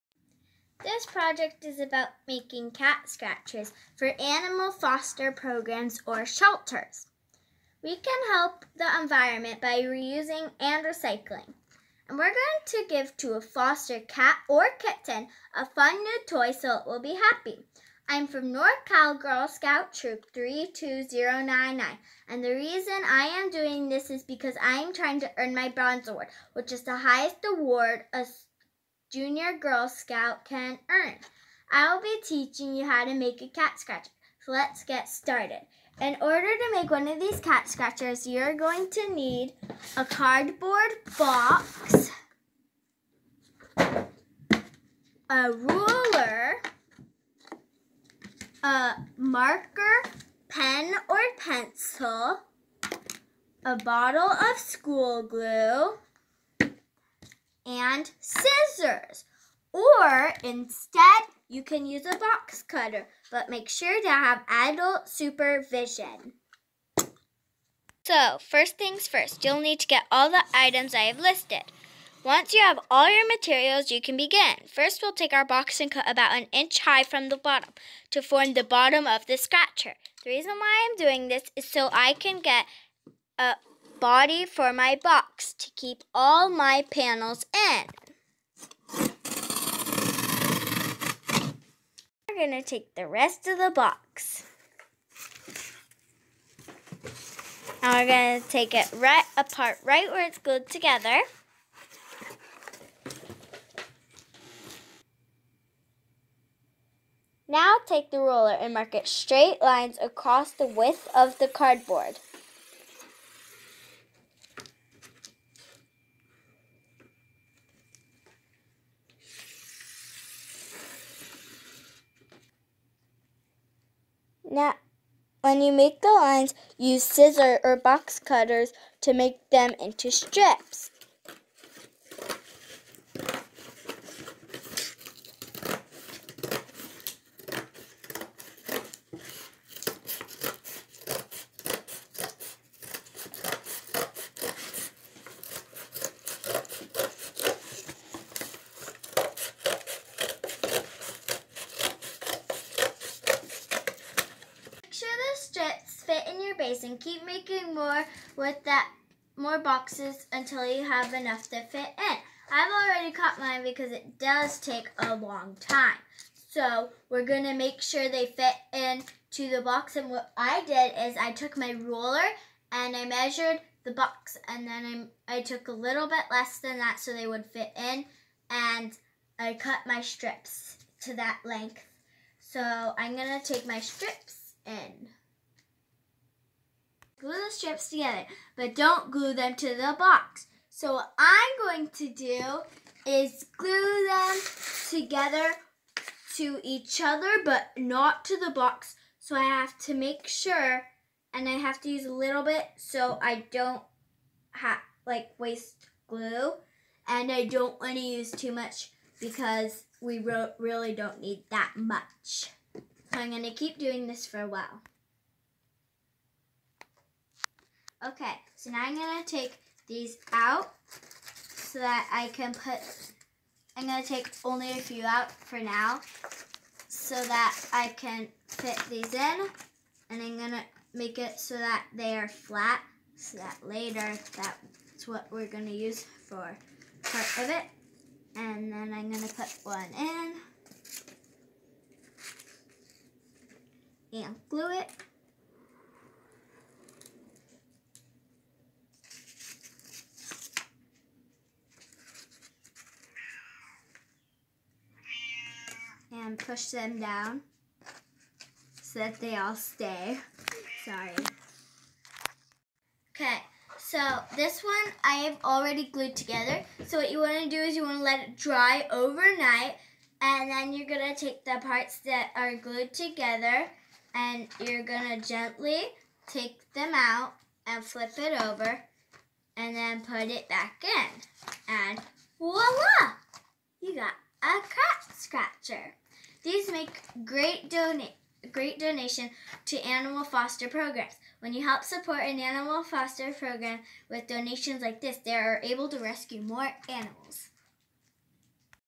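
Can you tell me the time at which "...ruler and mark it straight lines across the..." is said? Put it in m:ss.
1:48.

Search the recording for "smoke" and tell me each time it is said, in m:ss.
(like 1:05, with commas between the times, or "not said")
not said.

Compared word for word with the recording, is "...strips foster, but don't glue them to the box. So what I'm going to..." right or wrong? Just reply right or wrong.
wrong.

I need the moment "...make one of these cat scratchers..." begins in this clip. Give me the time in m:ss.
0:36.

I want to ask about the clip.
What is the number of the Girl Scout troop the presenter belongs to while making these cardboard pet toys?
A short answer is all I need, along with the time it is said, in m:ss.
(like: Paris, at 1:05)
32099, at 0:20.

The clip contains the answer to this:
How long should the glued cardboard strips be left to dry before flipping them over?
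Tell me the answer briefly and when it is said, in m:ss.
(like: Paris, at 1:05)
overnight, at 4:28.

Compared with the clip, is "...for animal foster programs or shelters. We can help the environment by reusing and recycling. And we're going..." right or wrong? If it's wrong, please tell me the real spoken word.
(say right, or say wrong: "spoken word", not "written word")
right.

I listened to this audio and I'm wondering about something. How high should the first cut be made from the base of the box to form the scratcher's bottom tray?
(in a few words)
about an inch.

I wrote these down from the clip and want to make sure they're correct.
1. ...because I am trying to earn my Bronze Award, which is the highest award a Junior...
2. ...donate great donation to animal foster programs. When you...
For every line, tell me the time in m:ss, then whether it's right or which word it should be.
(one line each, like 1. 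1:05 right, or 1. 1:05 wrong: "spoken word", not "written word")
1. 0:24 right
2. 4:47 right.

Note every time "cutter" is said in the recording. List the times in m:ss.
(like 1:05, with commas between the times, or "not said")
1:02, 2:08.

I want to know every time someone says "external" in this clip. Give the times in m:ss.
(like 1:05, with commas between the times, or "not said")
not said.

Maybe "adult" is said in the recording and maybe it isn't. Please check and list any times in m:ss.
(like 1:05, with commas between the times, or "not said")
1:04.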